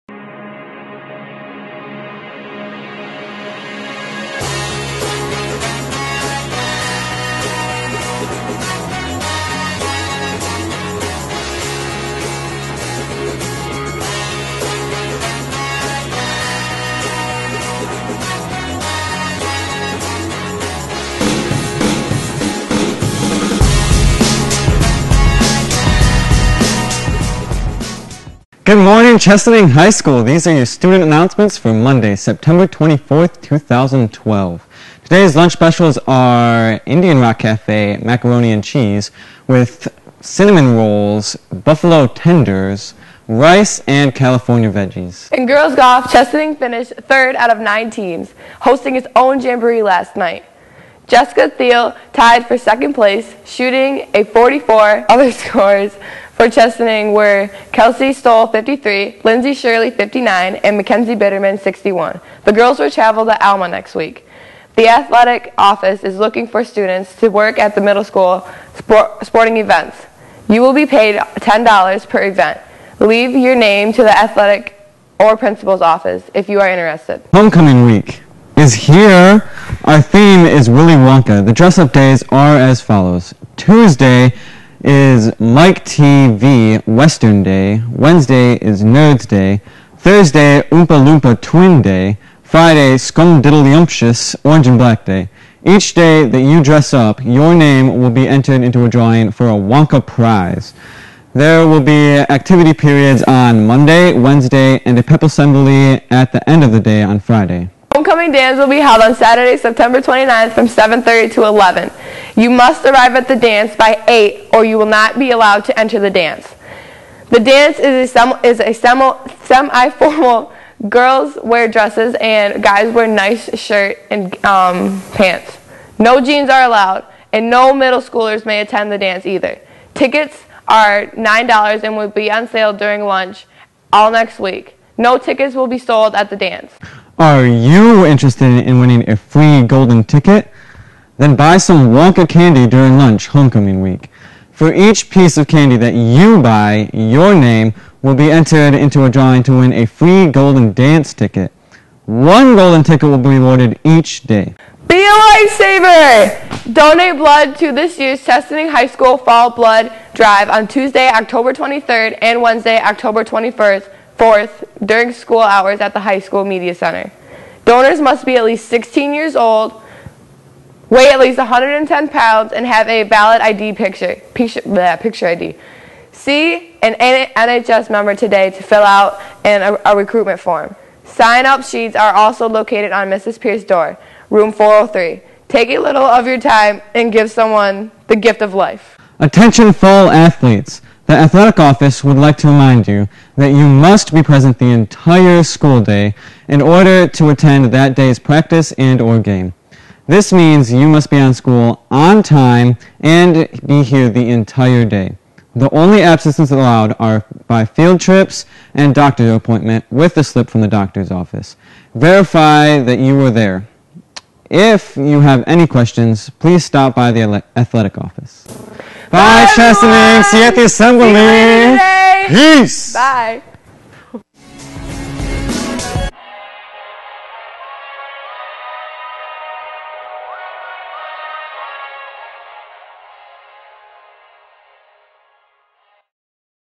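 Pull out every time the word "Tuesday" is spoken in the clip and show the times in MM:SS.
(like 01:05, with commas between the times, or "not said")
01:23, 02:40.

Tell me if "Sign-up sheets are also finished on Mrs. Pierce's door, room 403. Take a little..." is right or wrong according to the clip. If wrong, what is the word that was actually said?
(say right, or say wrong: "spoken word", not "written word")
wrong: "located", not "finished".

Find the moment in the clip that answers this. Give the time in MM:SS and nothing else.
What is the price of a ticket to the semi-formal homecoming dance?
02:11.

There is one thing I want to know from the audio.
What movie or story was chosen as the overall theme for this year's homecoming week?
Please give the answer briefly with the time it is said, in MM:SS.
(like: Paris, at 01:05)
Willy Wonka, at 01:20.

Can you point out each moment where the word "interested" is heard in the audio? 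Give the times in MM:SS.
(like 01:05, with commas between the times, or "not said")
01:16, 02:18.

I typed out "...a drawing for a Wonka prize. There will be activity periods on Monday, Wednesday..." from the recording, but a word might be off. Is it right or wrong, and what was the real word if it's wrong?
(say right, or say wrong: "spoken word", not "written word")
right.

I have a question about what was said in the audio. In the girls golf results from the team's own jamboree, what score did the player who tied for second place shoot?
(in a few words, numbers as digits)
44.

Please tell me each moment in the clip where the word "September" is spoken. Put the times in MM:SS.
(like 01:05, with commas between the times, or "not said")
00:32, 01:49.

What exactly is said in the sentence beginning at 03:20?
This means you must be on school on time and be here the entire day.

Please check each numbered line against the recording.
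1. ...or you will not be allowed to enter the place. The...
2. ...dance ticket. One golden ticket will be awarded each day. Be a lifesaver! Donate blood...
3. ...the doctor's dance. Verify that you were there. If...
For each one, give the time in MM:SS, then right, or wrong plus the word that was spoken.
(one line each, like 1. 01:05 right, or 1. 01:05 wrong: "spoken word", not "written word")
1. 01:54 wrong: "dance", not "place"
2. 02:30 right
3. 03:30 wrong: "office", not "dance".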